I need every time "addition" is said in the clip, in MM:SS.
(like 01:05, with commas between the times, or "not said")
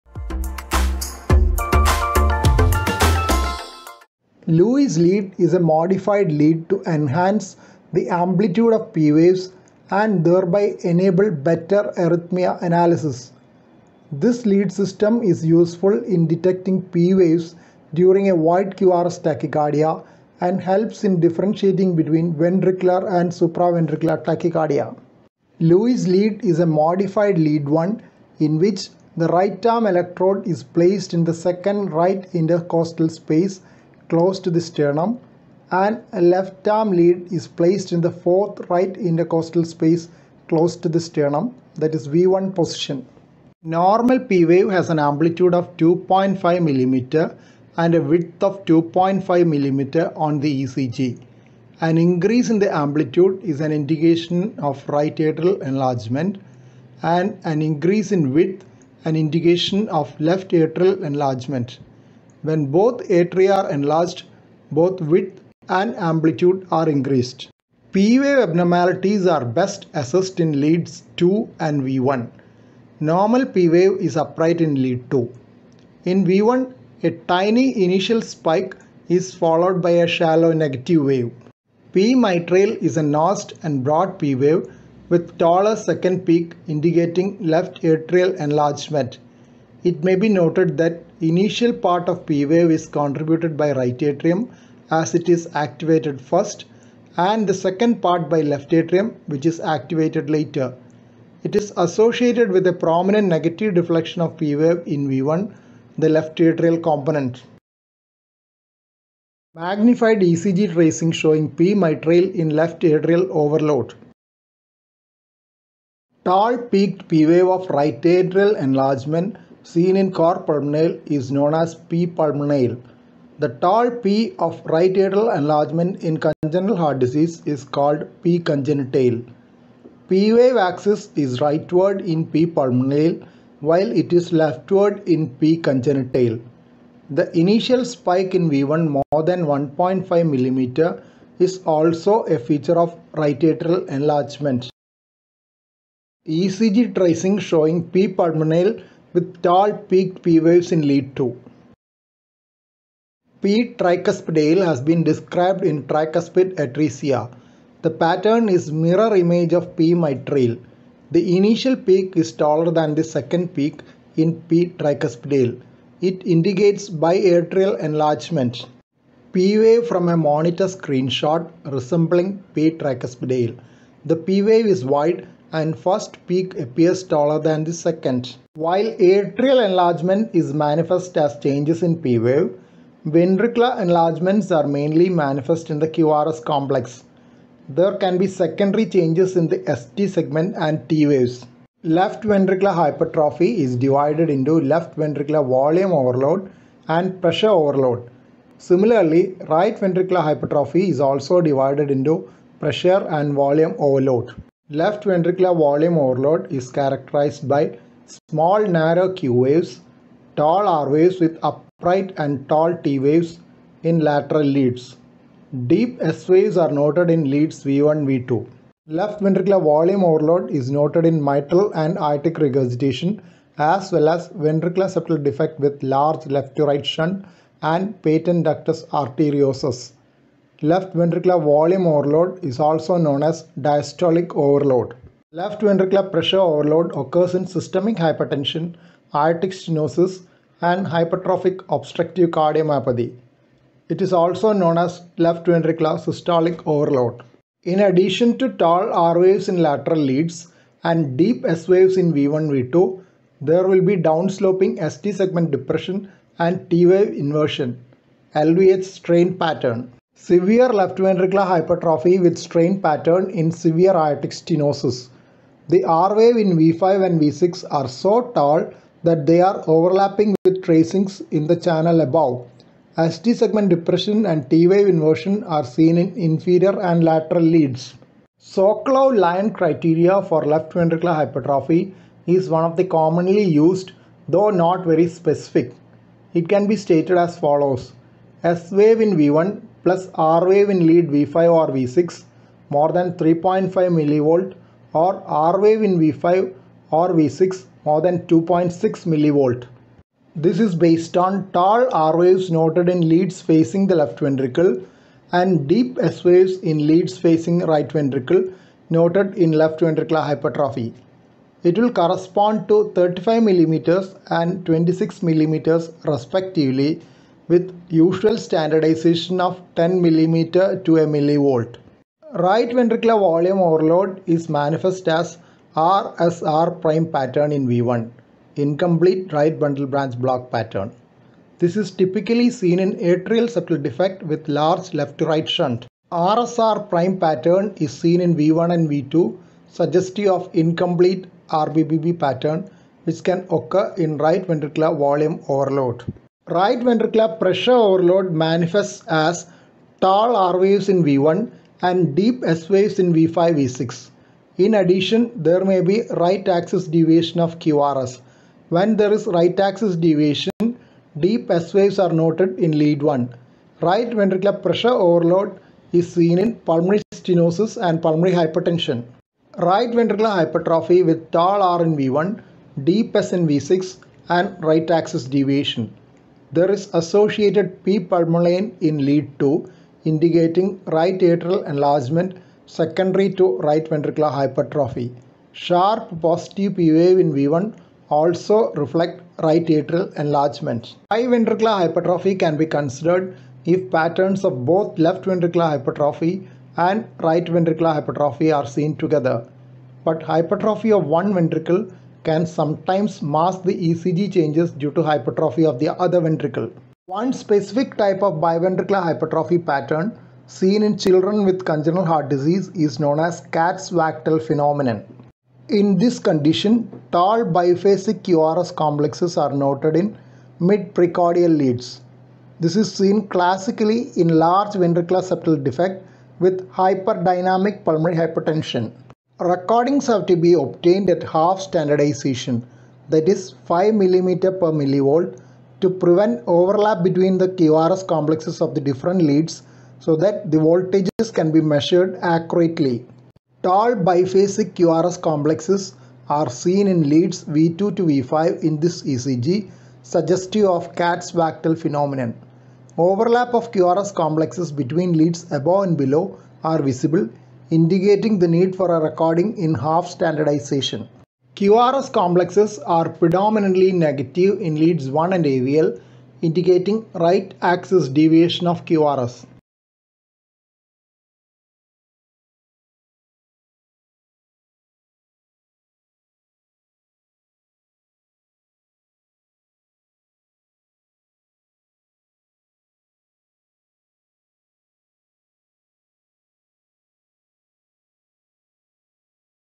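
04:07, 05:54.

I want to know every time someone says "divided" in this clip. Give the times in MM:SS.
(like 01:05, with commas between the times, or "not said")
03:13, 03:21.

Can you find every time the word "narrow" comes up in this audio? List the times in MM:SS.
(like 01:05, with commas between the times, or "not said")
03:28.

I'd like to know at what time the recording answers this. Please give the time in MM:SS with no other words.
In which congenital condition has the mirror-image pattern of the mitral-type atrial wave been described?
02:35.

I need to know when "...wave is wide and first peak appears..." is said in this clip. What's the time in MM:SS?
02:54.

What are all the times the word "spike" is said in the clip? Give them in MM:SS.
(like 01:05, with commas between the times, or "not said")
01:18, 02:17.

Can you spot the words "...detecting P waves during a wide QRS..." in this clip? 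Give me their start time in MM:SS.
00:16.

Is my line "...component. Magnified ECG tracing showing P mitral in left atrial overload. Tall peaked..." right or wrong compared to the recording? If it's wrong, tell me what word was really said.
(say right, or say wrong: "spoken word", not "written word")
right.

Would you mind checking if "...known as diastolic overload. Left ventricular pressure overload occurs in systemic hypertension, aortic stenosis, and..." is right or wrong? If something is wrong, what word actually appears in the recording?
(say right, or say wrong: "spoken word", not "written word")
right.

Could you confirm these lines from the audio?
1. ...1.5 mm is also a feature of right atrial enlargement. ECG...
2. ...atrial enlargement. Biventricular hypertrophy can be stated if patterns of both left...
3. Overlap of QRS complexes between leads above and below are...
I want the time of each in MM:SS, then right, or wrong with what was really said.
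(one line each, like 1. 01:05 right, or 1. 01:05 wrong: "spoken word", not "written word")
1. 02:19 right
2. 06:29 wrong: "considered", not "stated"
3. 07:32 right.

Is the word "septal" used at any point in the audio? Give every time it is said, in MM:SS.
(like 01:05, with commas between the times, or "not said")
03:44, 05:33, 07:05.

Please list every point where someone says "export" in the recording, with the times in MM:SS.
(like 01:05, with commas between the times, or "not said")
not said.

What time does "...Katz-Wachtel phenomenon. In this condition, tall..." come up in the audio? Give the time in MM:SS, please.
06:53.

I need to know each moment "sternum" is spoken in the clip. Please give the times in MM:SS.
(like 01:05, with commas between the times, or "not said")
00:34, 00:40.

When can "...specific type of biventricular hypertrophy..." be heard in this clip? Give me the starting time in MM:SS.
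06:47.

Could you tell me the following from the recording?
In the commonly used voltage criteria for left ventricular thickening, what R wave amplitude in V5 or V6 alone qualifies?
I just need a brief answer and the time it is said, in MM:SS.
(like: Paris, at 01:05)
2.6 millivolt, at 04:58.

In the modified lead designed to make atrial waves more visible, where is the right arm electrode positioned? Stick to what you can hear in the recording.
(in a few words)
second right intercostal space.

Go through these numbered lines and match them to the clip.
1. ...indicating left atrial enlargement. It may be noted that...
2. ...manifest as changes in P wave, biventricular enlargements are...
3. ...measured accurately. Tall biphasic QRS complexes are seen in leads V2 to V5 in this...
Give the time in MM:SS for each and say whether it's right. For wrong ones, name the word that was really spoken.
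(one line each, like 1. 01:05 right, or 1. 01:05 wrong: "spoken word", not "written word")
1. 01:26 right
2. 03:00 wrong: "ventricular", not "biventricular"
3. 07:21 right.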